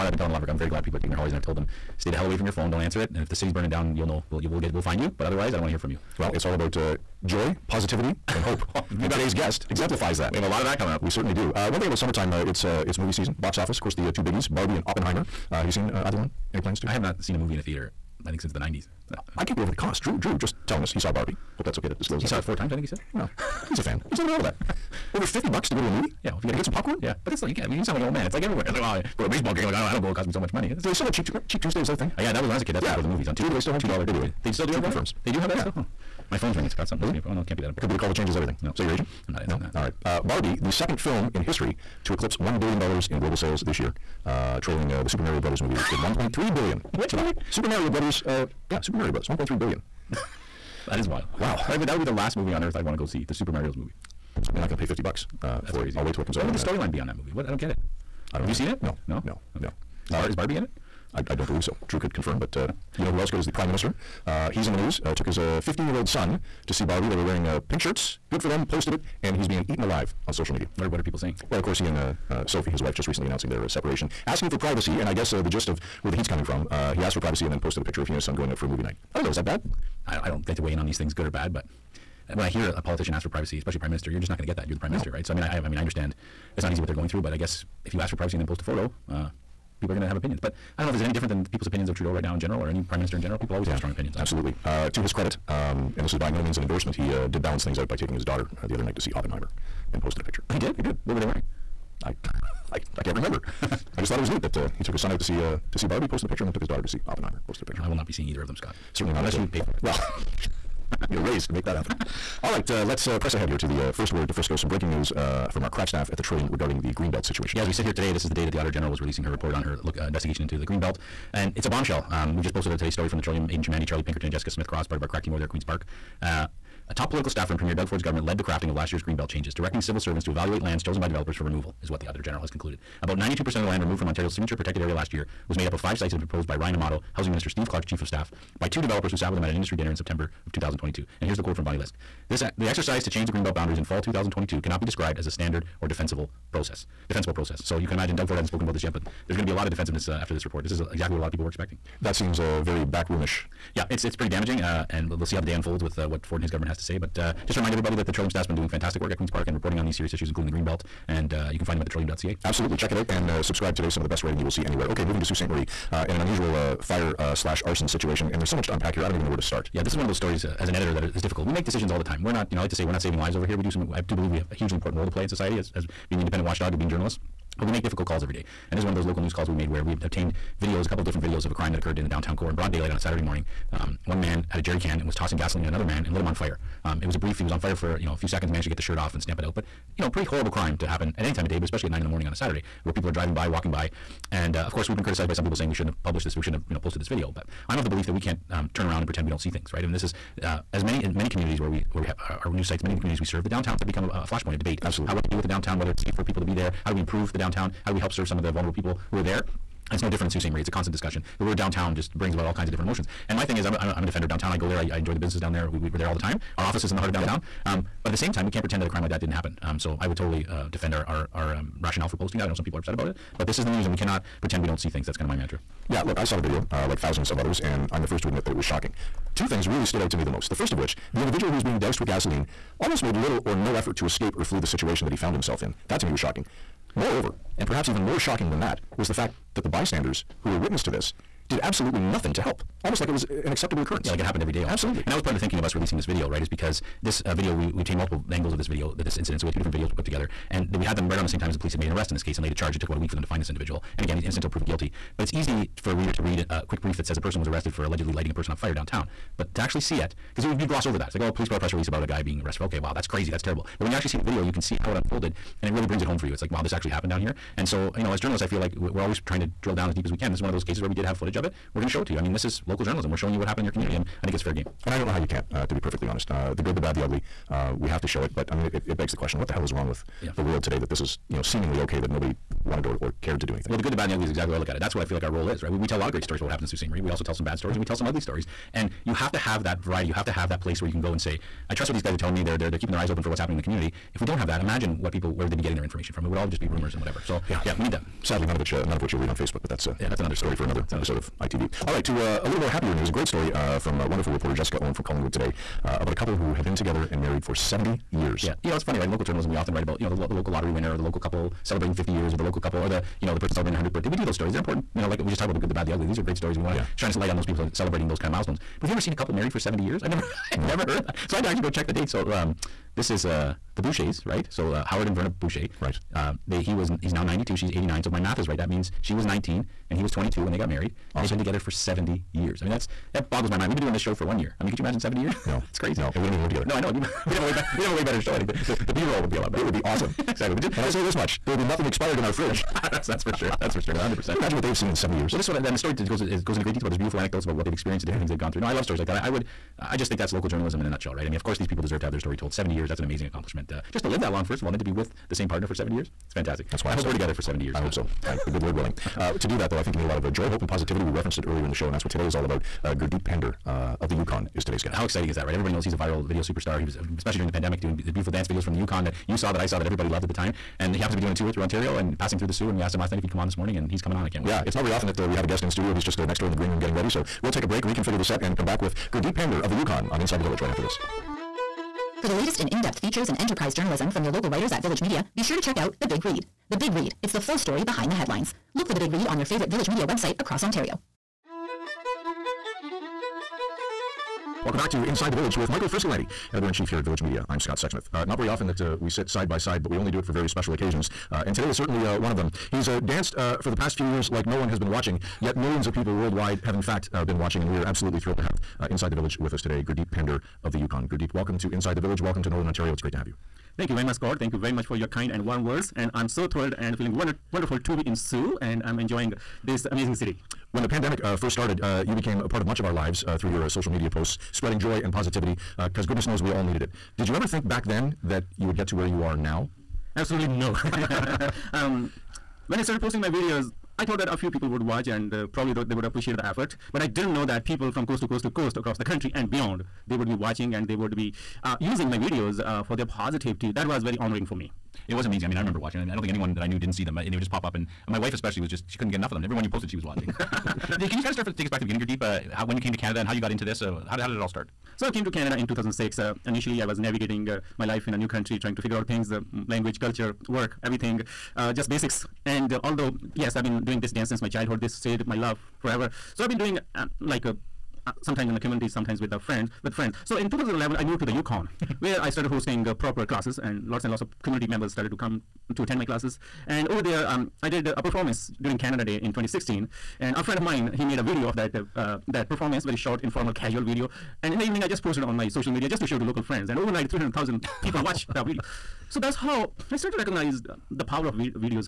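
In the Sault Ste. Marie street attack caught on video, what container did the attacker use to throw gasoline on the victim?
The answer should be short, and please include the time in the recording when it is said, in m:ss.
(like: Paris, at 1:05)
Jerry can, at 3:04.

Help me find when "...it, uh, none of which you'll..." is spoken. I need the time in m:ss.
4:58.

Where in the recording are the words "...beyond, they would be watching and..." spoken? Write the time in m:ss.
7:19.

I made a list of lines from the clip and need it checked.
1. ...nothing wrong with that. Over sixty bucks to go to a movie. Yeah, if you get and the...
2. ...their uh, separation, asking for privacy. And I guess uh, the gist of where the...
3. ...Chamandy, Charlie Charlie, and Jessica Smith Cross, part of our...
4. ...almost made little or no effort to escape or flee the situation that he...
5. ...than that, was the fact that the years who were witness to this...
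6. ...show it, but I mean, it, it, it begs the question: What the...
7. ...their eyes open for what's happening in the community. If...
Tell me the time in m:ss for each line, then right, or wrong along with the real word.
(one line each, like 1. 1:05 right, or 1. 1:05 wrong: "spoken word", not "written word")
1. 0:24 wrong: "fifty", not "sixty"
2. 1:13 right
3. 2:03 wrong: "Pinkerton", not "Charlie"
4. 3:52 right
5. 3:58 wrong: "bystanders", not "years"
6. 4:38 right
7. 4:52 right.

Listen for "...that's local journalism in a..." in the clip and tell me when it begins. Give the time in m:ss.
5:50.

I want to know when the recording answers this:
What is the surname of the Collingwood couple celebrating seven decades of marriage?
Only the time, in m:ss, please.
5:23.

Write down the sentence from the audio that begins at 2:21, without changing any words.
And here's the quote from Bonnie Lysyk.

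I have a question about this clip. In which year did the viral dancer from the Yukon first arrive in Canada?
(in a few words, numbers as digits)
2006.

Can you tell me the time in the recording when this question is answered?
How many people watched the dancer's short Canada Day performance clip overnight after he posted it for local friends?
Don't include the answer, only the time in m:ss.
8:07.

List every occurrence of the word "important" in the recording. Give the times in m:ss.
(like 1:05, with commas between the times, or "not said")
0:37, 2:54, 5:14.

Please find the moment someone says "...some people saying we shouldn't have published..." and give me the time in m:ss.
3:15.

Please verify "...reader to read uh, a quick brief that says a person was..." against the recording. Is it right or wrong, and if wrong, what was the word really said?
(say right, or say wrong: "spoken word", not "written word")
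right.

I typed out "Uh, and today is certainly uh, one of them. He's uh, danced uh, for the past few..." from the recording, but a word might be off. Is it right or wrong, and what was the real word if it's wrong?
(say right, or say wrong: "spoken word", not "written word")
right.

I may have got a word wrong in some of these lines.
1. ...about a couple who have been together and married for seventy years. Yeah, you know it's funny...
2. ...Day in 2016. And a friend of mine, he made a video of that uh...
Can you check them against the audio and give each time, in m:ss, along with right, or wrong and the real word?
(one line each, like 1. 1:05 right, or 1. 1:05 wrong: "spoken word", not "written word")
1. 5:05 right
2. 7:59 right.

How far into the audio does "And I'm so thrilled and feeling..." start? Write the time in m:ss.
6:55.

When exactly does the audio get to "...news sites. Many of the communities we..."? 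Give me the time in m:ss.
3:22.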